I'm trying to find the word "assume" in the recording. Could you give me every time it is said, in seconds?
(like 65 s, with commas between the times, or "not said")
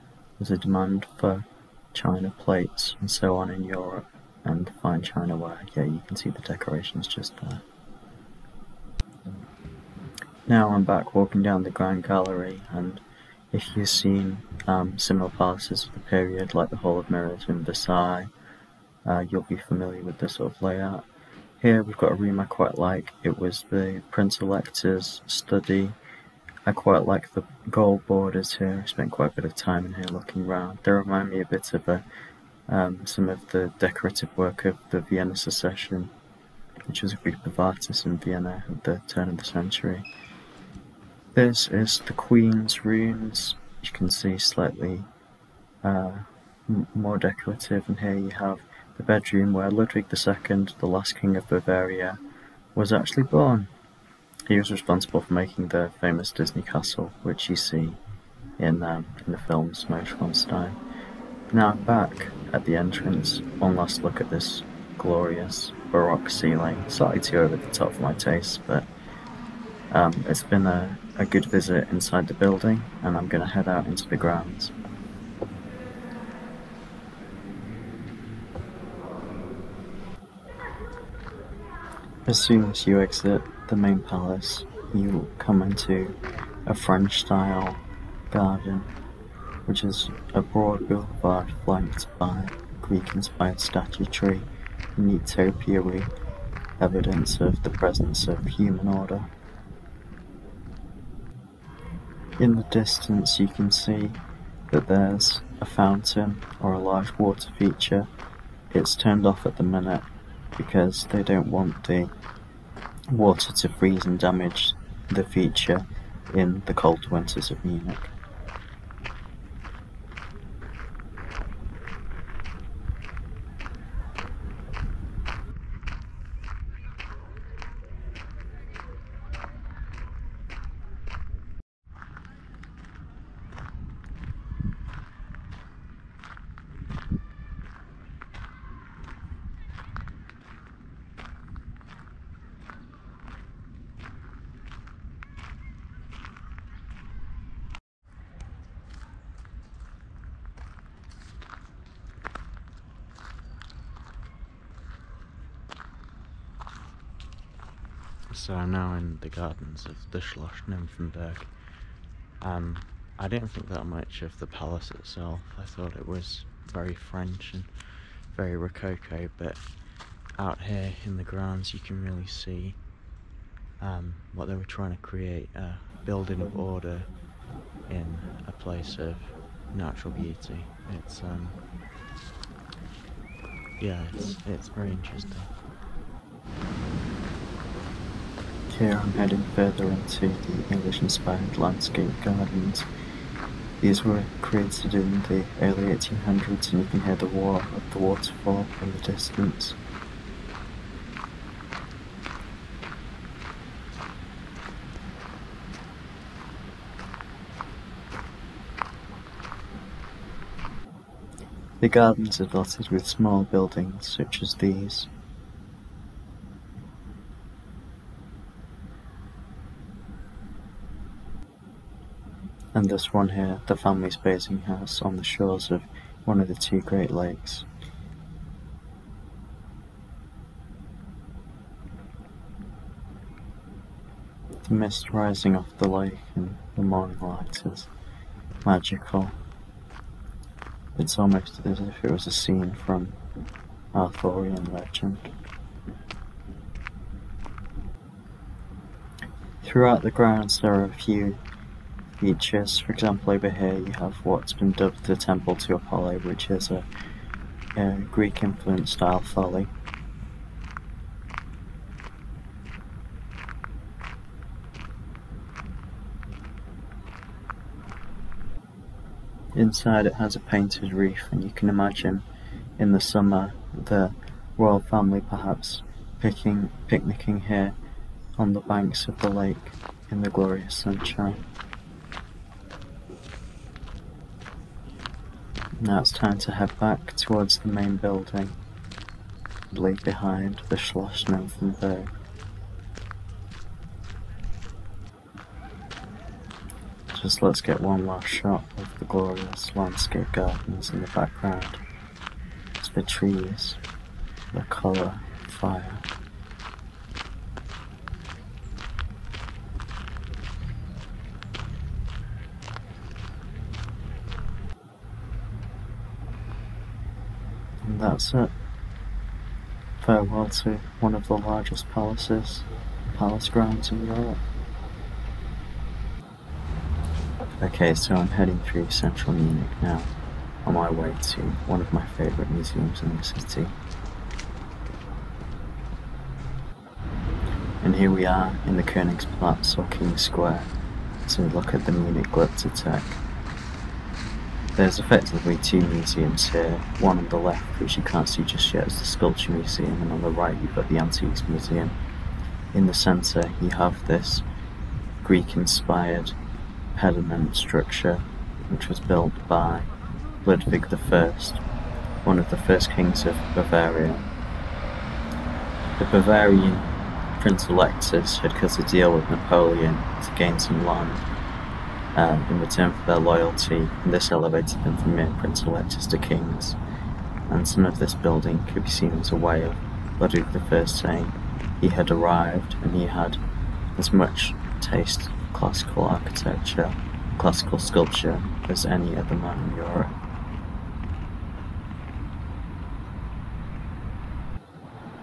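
not said.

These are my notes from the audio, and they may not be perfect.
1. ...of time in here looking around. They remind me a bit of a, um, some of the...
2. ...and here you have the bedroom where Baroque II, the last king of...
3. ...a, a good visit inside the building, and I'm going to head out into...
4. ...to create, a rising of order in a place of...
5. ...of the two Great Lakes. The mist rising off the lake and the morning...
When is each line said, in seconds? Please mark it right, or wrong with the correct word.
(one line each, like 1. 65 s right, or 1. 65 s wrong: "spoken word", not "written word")
1. 29 s right
2. 47 s wrong: "Ludwig", not "Baroque"
3. 70 s right
4. 174 s wrong: "building", not "rising"
5. 226 s right.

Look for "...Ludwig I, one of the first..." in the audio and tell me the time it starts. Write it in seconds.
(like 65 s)
360 s.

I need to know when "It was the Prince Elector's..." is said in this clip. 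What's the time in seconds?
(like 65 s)
23 s.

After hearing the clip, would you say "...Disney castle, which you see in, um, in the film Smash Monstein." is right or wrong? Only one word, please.
right.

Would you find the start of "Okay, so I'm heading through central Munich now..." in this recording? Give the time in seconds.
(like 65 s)
327 s.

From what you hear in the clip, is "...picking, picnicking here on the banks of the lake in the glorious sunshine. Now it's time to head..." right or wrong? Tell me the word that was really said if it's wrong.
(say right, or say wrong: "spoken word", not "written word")
right.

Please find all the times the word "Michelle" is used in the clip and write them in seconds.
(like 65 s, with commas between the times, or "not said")
not said.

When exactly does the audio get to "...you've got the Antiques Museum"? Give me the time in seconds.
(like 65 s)
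350 s.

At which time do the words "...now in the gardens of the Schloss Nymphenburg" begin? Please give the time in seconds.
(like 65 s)
158 s.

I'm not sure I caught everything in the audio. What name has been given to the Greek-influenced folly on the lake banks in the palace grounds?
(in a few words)
Temple to Apollo.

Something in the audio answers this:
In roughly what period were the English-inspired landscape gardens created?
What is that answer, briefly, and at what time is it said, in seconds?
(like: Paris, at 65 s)
Early 1800s, at 195 s.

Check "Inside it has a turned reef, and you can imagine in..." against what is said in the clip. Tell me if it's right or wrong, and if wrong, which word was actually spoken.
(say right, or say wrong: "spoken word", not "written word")
wrong: "painted", not "turned".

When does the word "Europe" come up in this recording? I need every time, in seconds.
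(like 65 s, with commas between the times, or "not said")
3 s, 324 s, 389 s.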